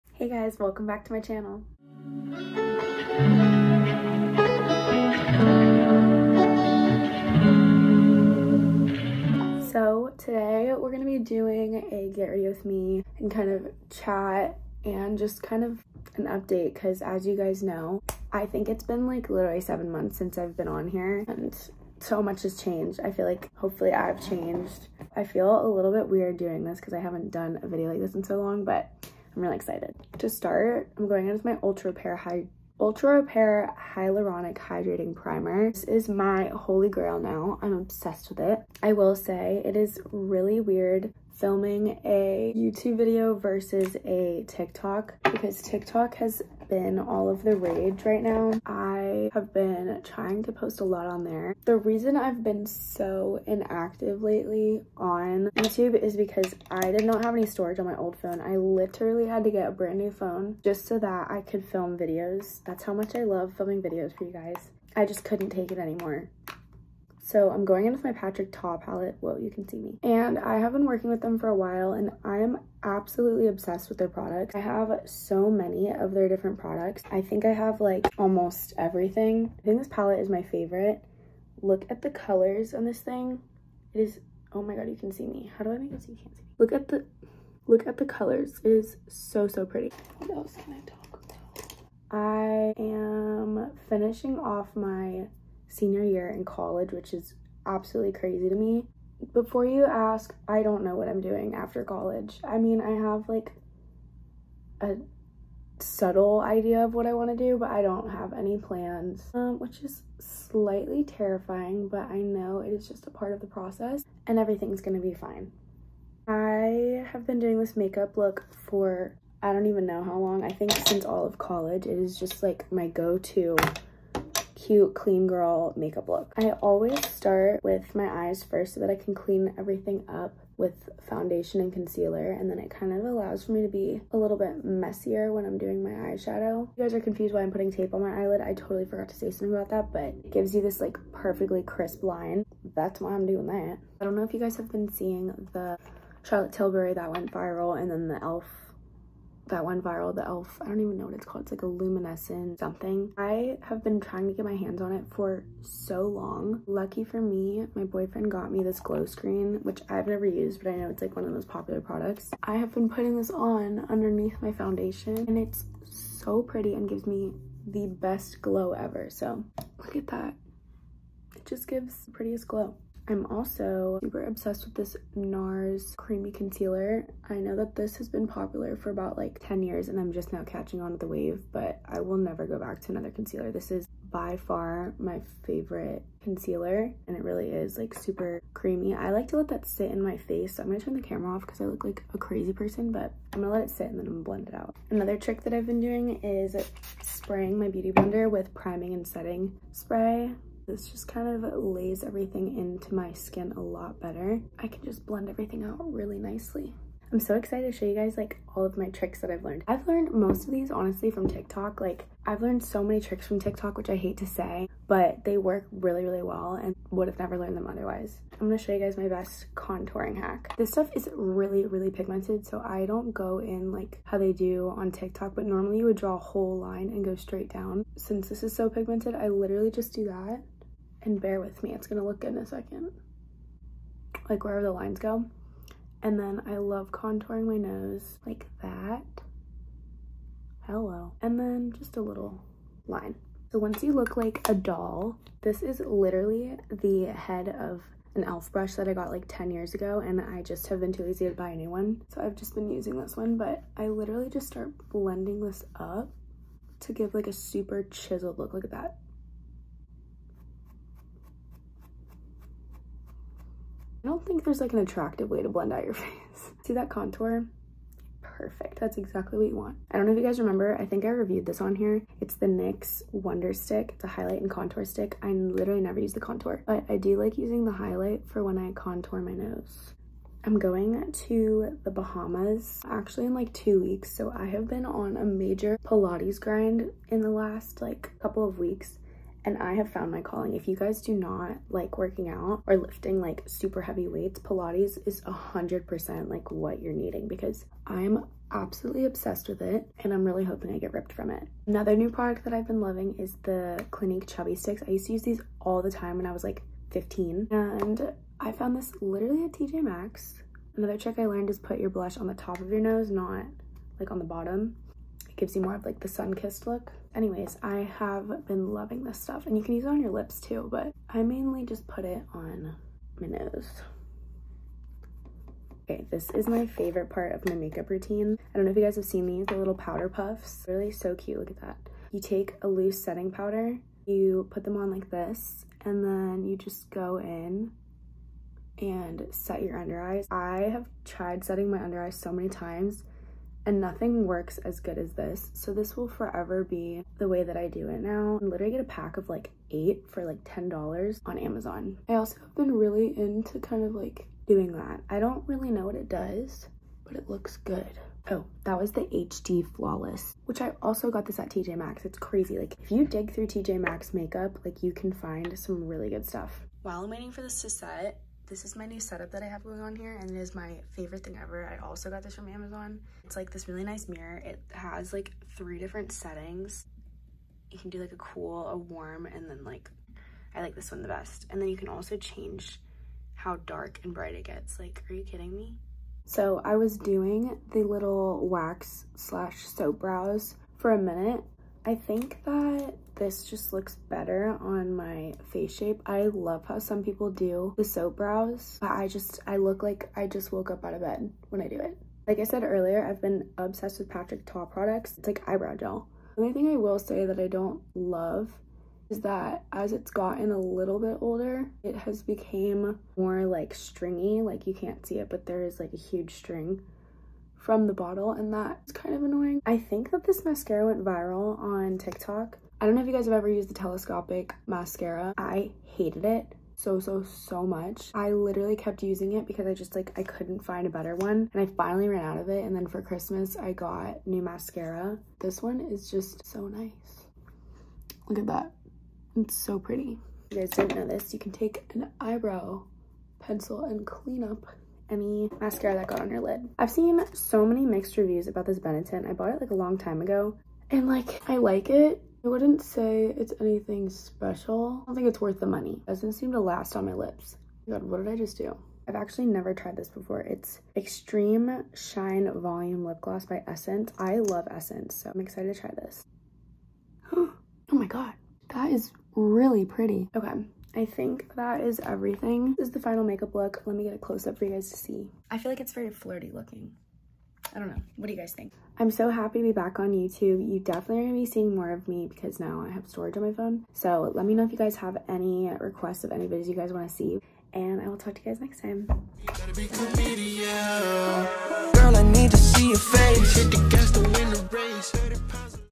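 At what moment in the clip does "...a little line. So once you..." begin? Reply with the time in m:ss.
4:01.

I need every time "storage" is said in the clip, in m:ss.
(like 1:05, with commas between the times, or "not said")
0:57, 8:03.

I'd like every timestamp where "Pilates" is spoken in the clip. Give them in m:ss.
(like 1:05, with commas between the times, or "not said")
4:45, 4:54.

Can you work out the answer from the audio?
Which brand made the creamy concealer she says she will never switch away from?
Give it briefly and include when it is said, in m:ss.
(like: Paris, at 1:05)
NARS, at 2:55.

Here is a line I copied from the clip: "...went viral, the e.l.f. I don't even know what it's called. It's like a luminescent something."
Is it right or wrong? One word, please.
right.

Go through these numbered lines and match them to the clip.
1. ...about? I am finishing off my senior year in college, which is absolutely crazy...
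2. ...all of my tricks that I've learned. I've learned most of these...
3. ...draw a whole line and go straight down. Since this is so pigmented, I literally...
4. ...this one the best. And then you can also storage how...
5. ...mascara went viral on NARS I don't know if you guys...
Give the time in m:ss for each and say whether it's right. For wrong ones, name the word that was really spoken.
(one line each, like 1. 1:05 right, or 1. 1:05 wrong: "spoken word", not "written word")
1. 1:31 right
2. 3:28 right
3. 3:45 right
4. 6:20 wrong: "change", not "storage"
5. 7:00 wrong: "TikTok", not "NARS".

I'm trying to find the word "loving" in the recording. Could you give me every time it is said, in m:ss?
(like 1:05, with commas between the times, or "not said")
5:02, 5:18.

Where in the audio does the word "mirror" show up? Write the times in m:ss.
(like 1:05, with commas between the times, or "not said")
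6:14.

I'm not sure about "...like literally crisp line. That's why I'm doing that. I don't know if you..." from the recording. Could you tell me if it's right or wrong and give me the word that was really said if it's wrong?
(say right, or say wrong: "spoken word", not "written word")
wrong: "perfectly", not "literally".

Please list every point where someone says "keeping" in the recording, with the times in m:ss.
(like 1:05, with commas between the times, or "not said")
not said.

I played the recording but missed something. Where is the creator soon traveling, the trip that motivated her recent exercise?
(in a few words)
Bahamas.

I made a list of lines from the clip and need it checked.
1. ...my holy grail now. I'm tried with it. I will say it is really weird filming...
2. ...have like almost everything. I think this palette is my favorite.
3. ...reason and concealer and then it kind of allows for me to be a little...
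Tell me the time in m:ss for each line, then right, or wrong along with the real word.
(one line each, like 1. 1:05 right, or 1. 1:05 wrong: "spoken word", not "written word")
1. 0:36 wrong: "obsessed", not "tried"
2. 1:17 right
3. 2:11 wrong: "foundation", not "reason".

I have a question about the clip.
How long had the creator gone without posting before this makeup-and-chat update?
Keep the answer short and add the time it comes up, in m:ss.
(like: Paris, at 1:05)
7 months, at 0:19.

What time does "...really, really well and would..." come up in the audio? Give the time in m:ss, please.
3:35.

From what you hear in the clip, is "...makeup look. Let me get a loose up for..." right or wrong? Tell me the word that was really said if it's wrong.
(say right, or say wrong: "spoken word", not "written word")
wrong: "close", not "loose".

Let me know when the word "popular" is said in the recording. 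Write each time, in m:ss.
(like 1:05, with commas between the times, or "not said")
2:41, 2:58.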